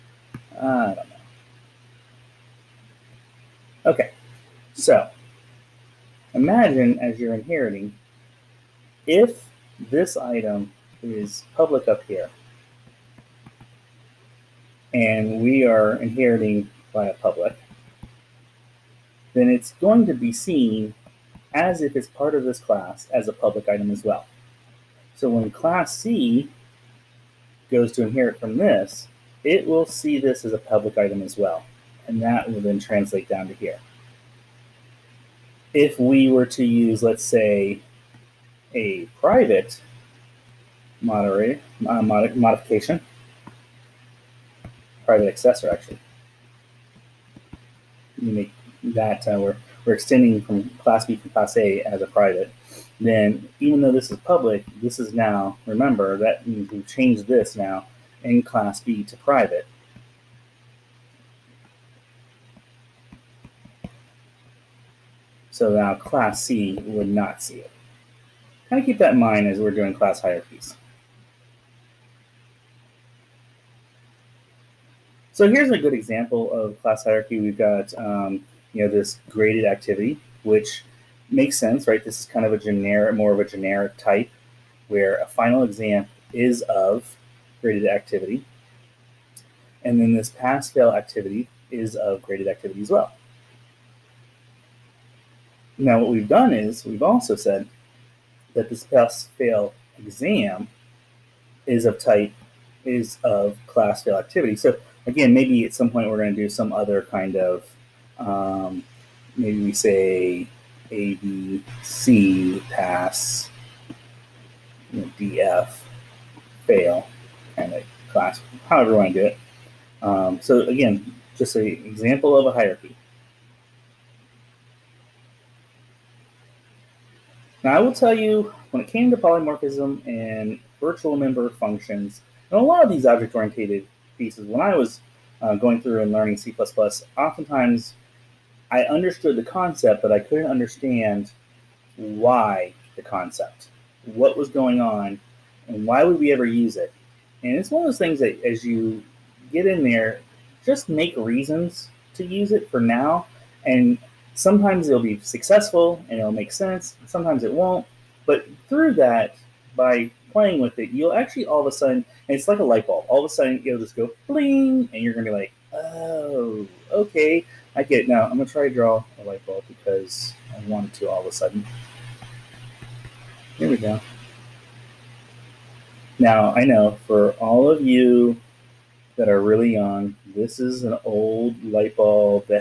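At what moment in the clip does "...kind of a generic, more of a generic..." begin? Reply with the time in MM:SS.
01:22.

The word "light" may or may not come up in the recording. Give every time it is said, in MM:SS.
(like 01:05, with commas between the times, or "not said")
02:42, 02:49, 03:01.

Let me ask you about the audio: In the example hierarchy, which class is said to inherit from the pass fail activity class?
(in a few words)
pass fail exam.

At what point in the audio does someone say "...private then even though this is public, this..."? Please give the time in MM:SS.
00:52.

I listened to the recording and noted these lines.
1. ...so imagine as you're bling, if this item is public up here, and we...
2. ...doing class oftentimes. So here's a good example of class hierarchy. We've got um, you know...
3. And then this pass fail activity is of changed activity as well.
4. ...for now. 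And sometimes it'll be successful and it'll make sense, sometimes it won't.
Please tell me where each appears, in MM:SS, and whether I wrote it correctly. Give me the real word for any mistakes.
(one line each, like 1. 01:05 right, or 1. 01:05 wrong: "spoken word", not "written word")
1. 00:04 wrong: "inheriting", not "bling"
2. 01:09 wrong: "hierarchies", not "oftentimes"
3. 01:29 wrong: "graded", not "changed"
4. 02:32 right.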